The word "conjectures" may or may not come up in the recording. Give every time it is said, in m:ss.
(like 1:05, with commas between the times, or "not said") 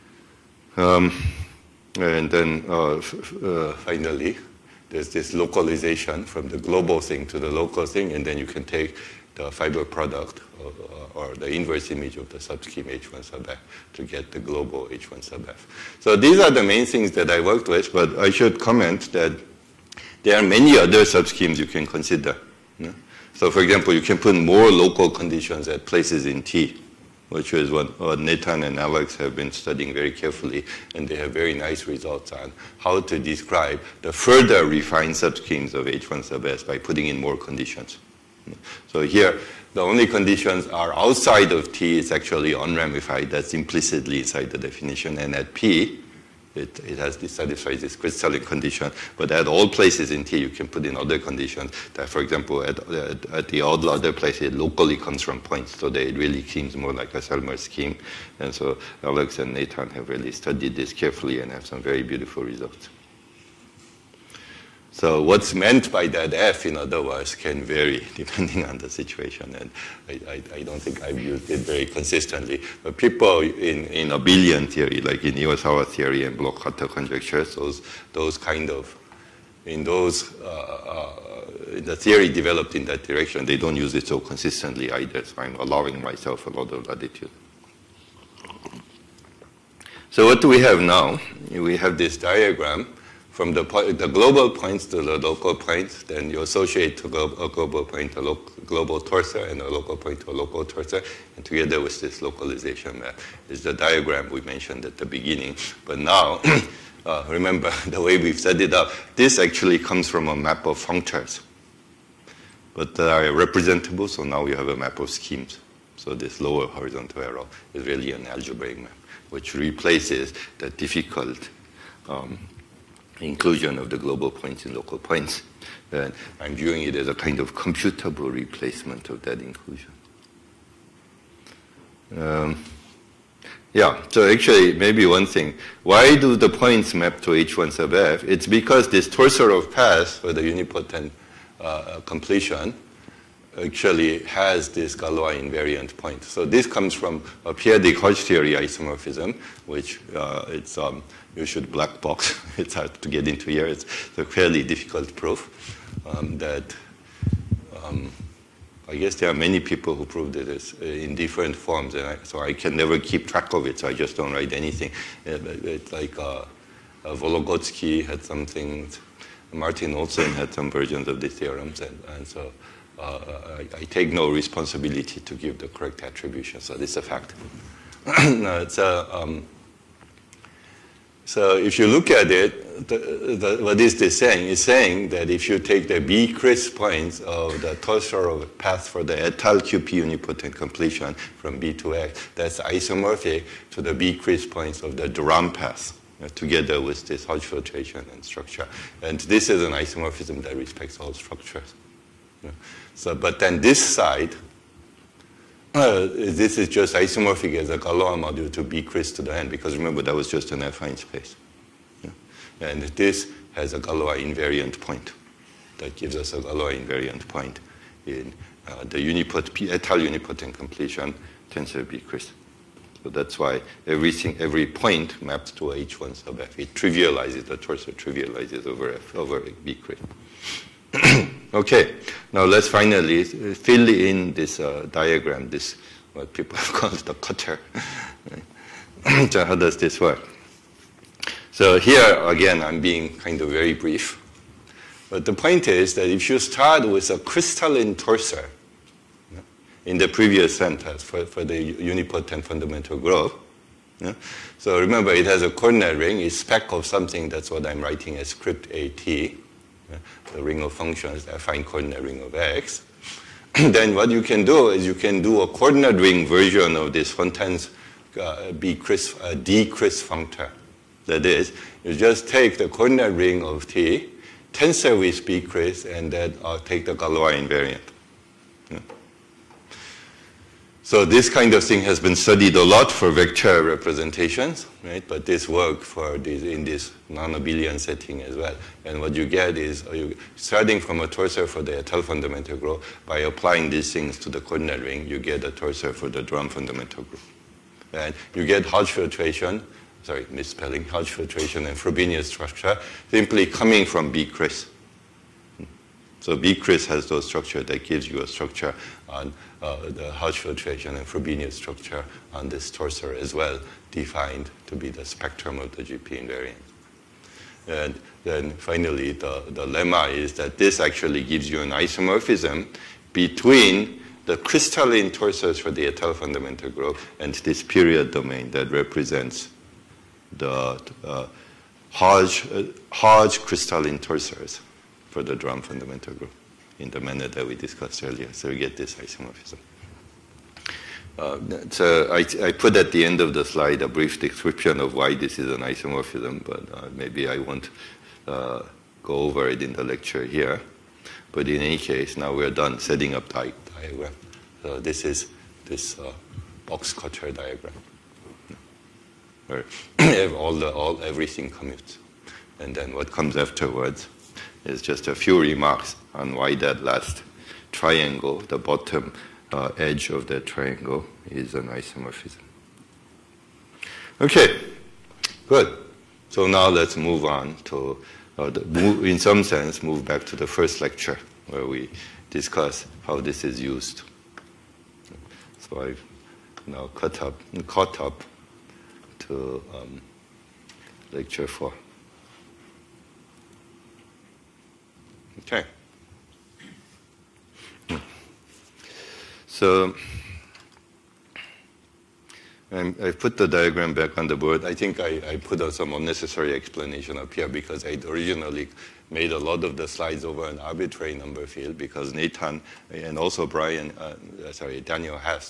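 1:16.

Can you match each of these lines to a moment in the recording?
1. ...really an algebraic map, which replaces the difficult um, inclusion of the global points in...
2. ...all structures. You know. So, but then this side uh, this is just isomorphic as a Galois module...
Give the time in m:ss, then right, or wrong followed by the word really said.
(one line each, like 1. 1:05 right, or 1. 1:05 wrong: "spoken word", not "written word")
1. 1:57 right
2. 3:20 right.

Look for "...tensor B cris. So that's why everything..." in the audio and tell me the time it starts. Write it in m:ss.
3:41.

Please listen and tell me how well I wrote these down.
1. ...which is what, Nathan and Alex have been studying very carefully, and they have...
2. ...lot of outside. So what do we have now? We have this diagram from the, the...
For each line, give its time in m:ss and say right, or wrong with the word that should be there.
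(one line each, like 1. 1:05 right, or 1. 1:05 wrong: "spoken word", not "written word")
1. 0:27 right
2. 1:26 wrong: "latitude", not "outside".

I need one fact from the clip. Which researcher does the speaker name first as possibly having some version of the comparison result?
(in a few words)
Vologodsky.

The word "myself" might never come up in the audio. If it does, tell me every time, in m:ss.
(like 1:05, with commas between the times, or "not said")
1:26.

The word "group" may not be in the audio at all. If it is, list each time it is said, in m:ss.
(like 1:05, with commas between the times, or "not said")
4:12, 4:52, 4:57, 5:26, 5:36.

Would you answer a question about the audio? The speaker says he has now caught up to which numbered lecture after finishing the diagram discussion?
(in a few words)
lecture 4.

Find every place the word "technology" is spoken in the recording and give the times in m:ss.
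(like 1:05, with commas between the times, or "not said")
not said.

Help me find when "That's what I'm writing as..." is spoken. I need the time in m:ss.
4:17.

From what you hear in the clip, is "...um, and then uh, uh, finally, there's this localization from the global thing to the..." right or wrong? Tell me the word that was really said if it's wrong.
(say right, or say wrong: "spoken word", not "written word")
right.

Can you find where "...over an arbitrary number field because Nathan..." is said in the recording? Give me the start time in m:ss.
6:50.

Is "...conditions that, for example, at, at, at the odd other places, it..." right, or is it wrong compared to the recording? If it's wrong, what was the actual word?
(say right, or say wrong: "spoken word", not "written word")
right.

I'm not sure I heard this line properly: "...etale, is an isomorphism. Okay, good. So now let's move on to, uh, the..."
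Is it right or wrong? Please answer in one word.
wrong.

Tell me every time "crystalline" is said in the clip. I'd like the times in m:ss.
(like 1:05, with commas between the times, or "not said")
0:47, 4:07, 5:24, 5:33.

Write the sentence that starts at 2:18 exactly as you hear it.
It's because this torsor of paths for the unipotent uh, completion actually has this Galois invariant point.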